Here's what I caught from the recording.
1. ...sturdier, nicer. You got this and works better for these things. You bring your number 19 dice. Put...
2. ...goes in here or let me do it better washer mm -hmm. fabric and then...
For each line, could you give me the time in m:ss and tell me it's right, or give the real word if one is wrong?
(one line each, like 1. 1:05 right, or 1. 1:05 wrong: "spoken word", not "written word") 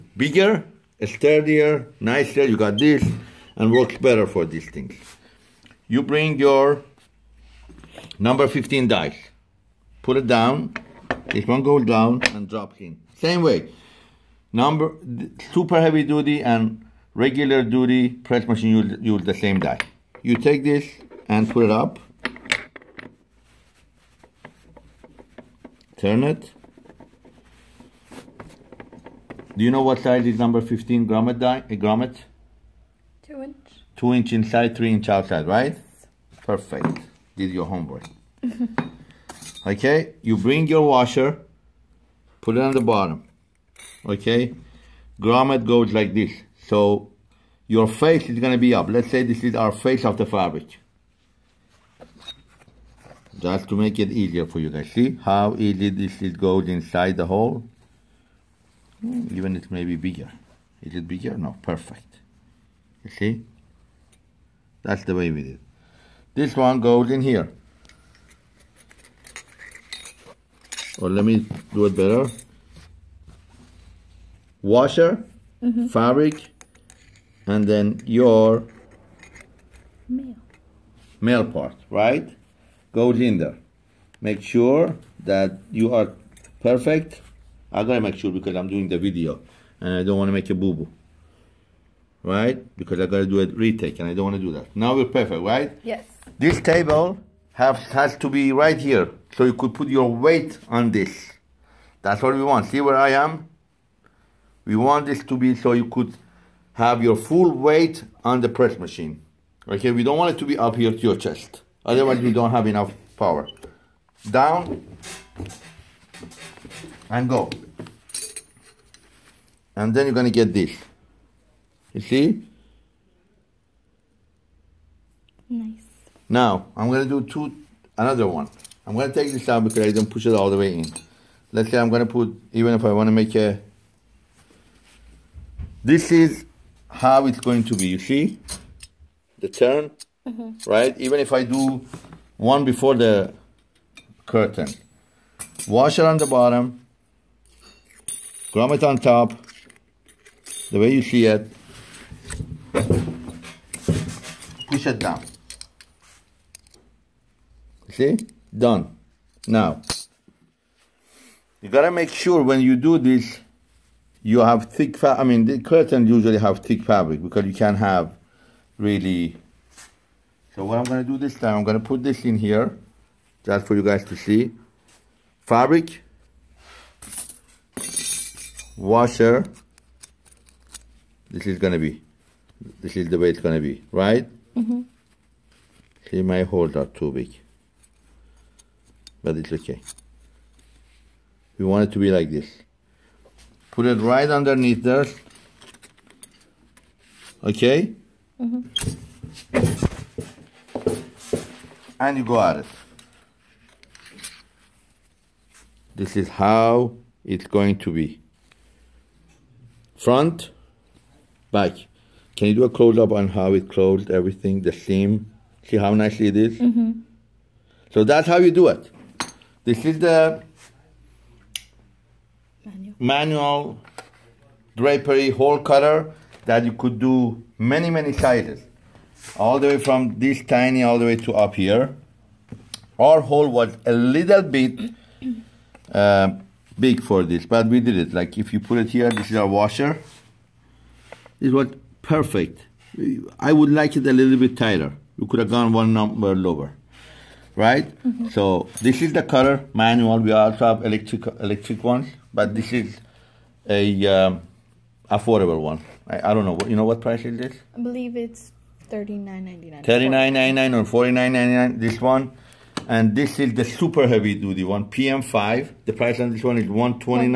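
1. 0:01 wrong: "15", not "19"
2. 1:06 right.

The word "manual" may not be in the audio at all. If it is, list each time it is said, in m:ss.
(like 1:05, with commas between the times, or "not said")
3:42, 4:09.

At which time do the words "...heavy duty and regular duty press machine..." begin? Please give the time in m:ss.
0:15.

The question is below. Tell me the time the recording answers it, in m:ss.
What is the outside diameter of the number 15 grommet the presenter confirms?
0:34.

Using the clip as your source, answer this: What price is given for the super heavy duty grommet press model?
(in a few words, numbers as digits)
$129.99.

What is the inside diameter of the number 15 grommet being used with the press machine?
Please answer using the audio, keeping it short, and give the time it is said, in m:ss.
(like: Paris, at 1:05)
2 inches, at 0:33.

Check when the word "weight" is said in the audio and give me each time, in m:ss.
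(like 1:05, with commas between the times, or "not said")
1:40, 1:47.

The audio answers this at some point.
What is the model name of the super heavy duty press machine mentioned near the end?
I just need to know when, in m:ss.
4:24.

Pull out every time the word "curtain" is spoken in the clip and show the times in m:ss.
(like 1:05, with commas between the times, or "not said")
2:24, 2:45.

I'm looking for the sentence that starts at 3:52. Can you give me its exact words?
Our hole was a little bit uh, big for this, but we did it.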